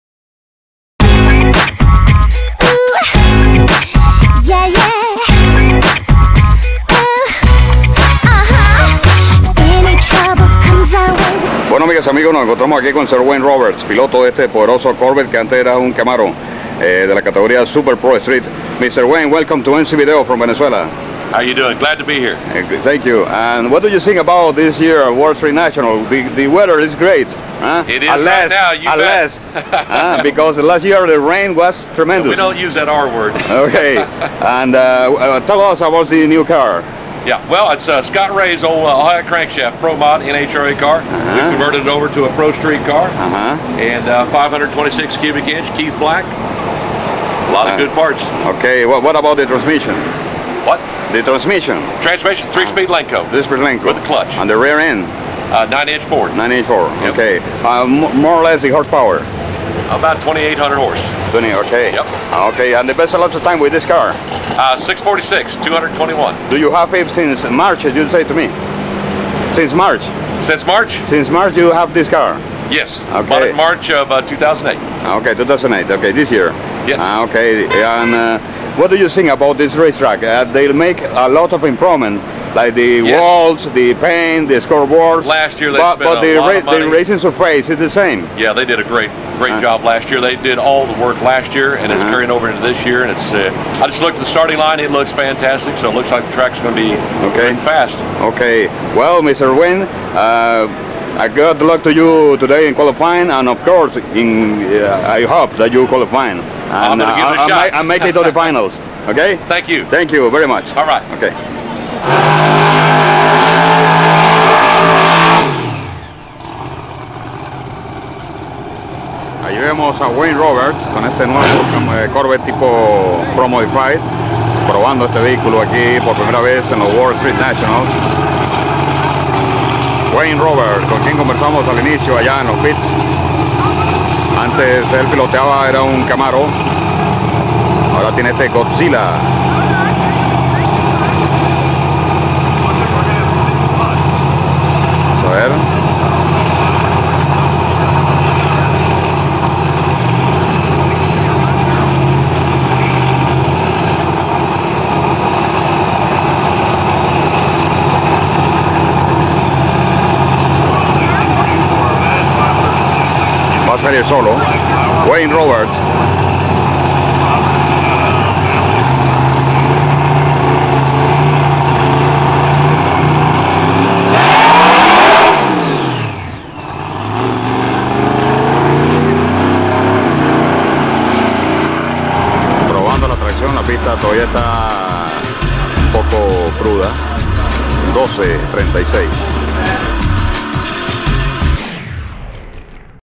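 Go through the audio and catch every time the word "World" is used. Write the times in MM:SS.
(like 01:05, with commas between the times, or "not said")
00:25, 02:06.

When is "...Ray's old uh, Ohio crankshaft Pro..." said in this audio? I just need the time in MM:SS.
00:38.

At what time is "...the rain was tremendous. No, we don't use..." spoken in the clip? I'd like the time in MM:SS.
00:31.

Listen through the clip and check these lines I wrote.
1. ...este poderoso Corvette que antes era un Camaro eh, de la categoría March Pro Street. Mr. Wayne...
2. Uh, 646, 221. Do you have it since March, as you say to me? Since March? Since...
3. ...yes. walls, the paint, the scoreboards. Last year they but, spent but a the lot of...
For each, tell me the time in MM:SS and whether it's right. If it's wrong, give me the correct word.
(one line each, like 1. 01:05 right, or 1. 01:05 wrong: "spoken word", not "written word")
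1. 00:14 wrong: "Super", not "March"
2. 01:04 right
3. 01:23 right.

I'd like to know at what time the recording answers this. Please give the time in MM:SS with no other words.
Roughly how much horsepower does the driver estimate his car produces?
01:00.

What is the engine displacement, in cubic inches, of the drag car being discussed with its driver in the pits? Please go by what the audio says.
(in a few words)
526.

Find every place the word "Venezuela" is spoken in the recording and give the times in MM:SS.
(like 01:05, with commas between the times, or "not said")
00:20.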